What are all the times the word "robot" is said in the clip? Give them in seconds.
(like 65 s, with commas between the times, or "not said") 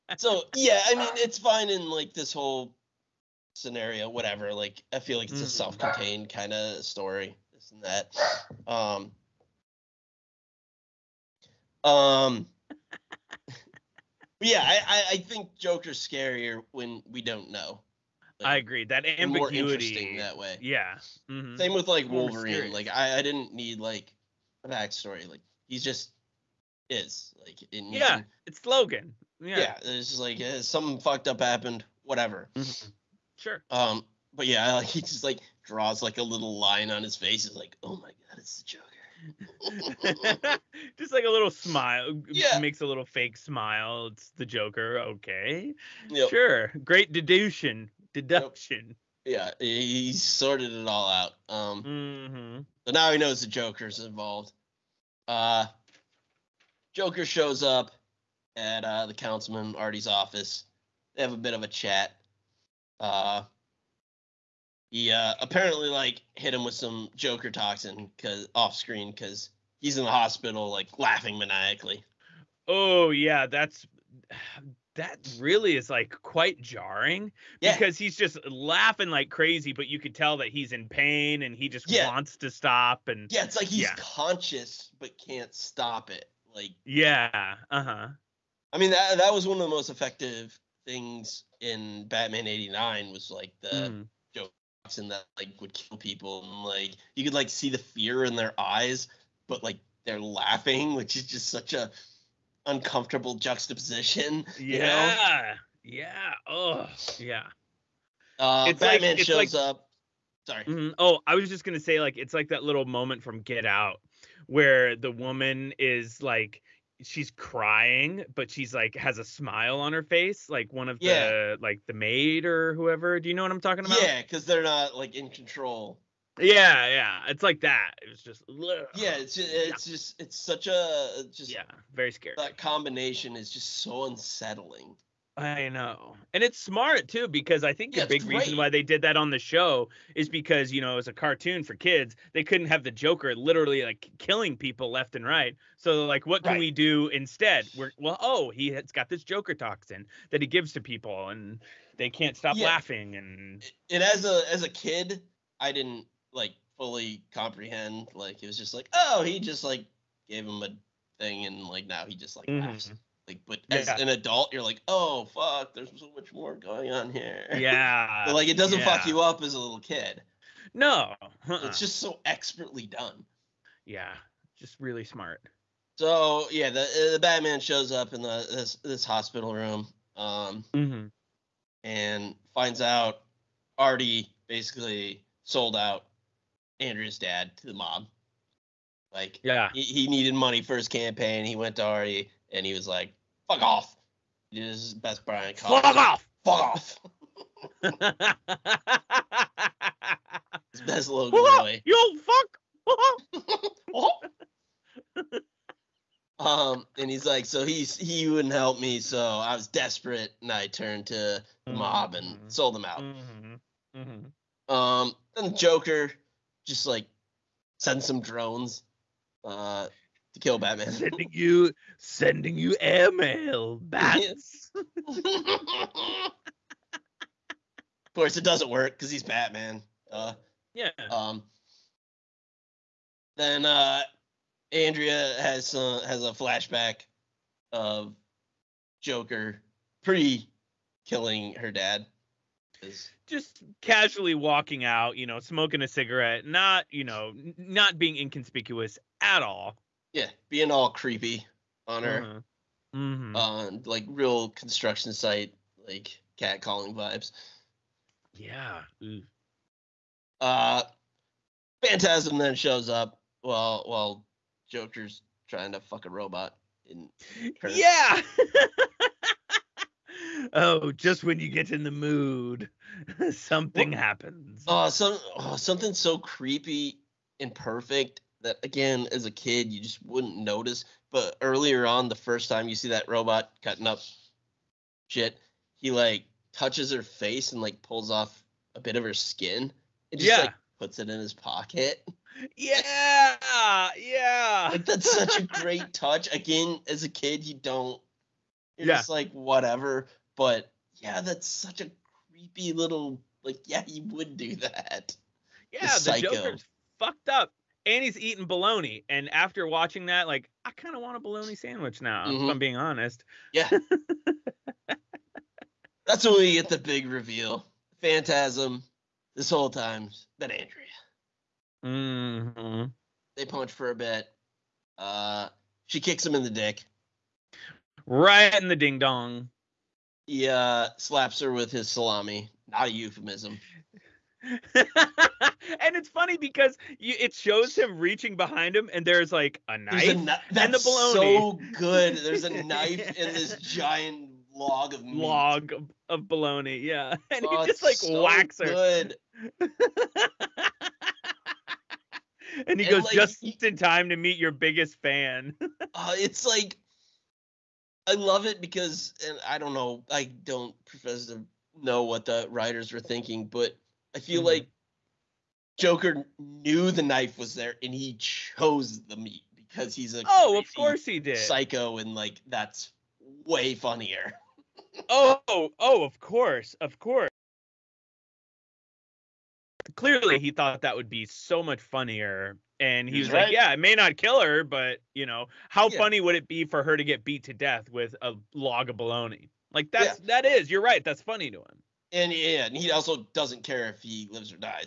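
266 s, 283 s.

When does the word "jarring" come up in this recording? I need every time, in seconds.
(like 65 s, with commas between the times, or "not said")
76 s.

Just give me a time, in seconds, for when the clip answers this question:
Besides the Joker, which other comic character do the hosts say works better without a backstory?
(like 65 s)
22 s.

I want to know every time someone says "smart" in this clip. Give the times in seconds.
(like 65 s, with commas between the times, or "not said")
136 s, 175 s.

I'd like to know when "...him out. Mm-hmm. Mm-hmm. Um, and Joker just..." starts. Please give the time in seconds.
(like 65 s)
212 s.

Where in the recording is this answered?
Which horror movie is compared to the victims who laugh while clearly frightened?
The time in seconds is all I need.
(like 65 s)
113 s.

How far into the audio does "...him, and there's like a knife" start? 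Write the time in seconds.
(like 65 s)
338 s.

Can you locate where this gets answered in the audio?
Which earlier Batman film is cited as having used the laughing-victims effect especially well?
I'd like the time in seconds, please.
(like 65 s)
92 s.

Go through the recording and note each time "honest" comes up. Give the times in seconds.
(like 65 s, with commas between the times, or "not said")
312 s.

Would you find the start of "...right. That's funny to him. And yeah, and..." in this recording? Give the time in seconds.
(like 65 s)
390 s.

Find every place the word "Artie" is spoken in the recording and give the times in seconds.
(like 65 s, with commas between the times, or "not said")
59 s, 183 s, 191 s.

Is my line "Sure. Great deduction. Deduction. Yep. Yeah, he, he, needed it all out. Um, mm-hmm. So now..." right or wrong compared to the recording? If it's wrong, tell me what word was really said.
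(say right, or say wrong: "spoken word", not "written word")
wrong: "sorted", not "needed".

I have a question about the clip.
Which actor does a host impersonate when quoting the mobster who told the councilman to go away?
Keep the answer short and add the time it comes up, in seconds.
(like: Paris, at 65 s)
Brian Cox, at 195 s.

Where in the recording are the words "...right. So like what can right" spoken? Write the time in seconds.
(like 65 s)
145 s.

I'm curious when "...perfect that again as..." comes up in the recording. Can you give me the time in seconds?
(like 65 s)
277 s.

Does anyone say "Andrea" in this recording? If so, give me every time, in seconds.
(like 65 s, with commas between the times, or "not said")
186 s, 234 s, 320 s.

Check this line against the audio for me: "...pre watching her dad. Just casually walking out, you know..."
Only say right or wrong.
wrong.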